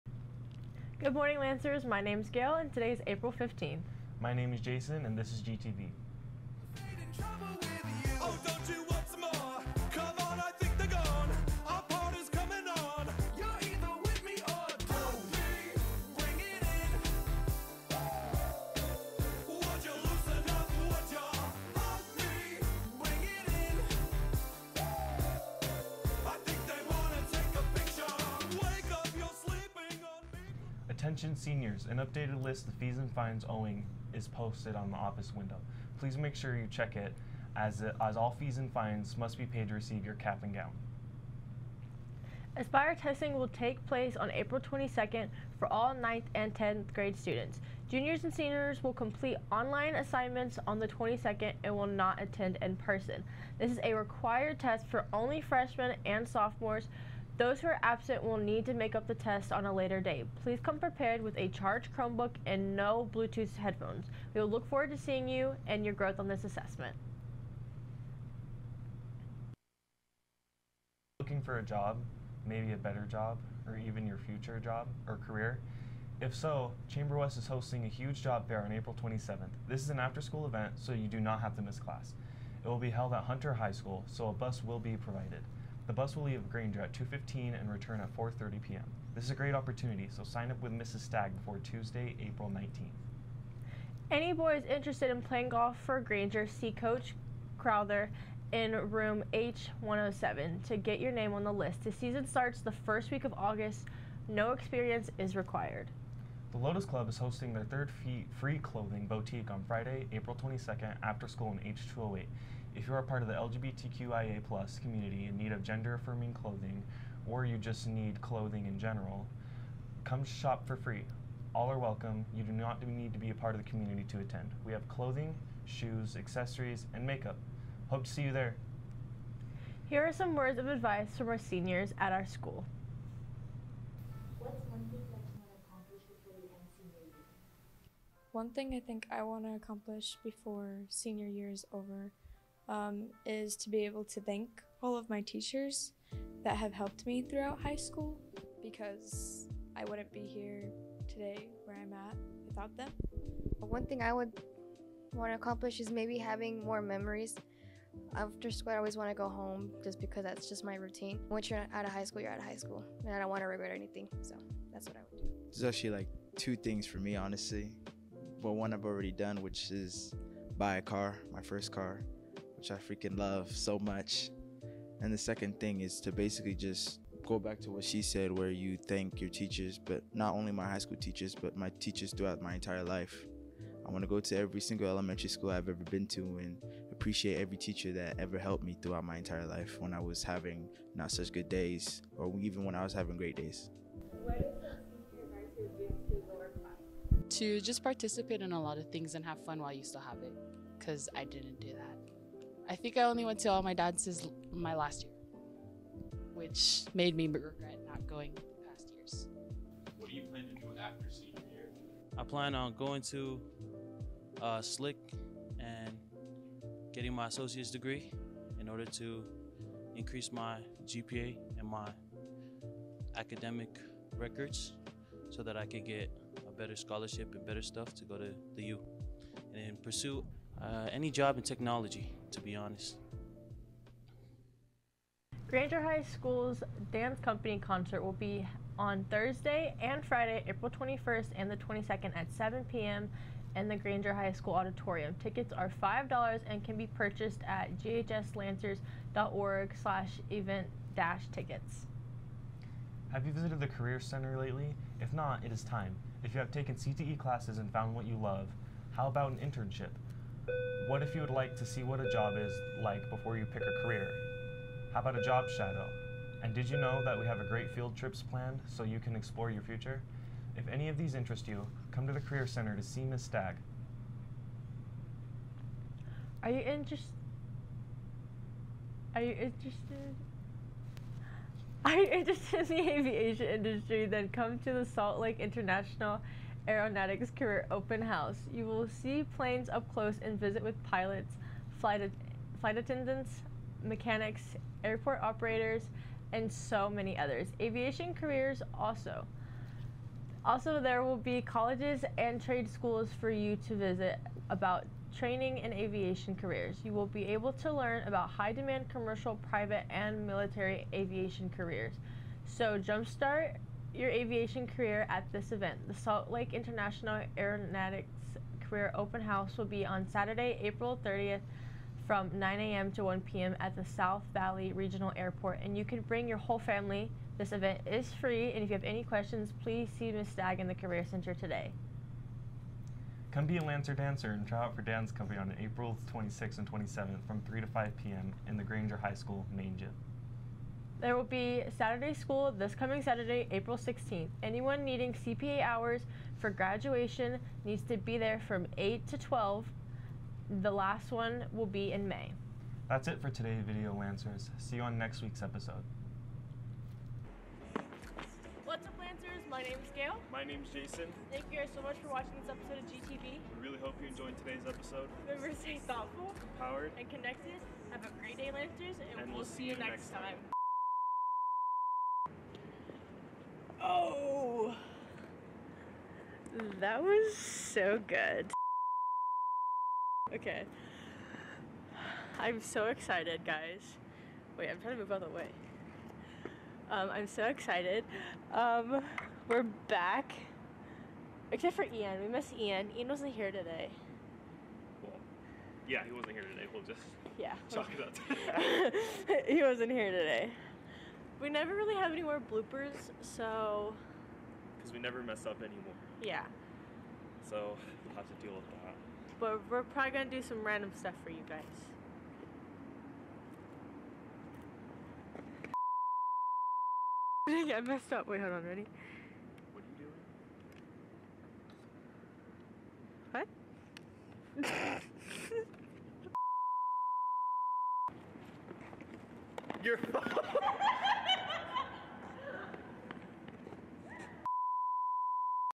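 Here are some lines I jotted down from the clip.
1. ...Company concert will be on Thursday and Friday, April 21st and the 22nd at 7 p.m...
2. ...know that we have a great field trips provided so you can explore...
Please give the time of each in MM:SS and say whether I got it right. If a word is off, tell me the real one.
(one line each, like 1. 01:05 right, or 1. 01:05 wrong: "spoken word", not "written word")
1. 03:57 right
2. 04:26 wrong: "planned", not "provided".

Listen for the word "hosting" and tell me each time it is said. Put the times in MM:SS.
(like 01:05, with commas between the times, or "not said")
01:17, 01:47.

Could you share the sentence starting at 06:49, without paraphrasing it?
But we're probably gonna do some random stuff for you guys.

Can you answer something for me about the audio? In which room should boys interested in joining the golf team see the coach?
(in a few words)
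H107.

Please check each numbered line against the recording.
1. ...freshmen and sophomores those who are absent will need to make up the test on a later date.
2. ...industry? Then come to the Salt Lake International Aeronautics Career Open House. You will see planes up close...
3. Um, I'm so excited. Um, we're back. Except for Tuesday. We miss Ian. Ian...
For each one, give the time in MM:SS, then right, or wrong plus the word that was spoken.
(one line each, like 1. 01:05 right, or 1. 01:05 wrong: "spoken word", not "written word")
1. 00:55 right
2. 04:43 right
3. 06:26 wrong: "Ian", not "Tuesday".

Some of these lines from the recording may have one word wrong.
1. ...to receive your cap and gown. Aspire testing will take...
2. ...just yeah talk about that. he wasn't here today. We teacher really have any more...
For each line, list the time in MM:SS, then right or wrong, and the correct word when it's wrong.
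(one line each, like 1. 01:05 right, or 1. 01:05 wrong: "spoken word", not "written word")
1. 00:39 right
2. 06:36 wrong: "never", not "teacher".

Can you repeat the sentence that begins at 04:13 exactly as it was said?
Have you visited the Career Center lately?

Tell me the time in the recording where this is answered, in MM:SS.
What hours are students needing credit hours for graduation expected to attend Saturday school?
05:48.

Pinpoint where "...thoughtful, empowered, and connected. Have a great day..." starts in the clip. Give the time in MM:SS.
06:05.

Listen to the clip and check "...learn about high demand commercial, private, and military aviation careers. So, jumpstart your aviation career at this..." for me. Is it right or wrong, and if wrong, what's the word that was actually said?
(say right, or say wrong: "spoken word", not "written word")
right.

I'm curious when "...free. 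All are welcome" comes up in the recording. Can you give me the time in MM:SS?
02:00.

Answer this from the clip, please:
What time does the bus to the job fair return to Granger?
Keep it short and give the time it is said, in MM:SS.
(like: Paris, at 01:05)
4:30 p.m., at 01:28.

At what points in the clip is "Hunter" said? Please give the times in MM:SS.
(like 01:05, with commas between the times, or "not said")
01:23.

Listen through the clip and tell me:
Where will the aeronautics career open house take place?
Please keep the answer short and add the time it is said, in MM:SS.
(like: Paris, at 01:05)
South Valley Regional Airport, at 05:23.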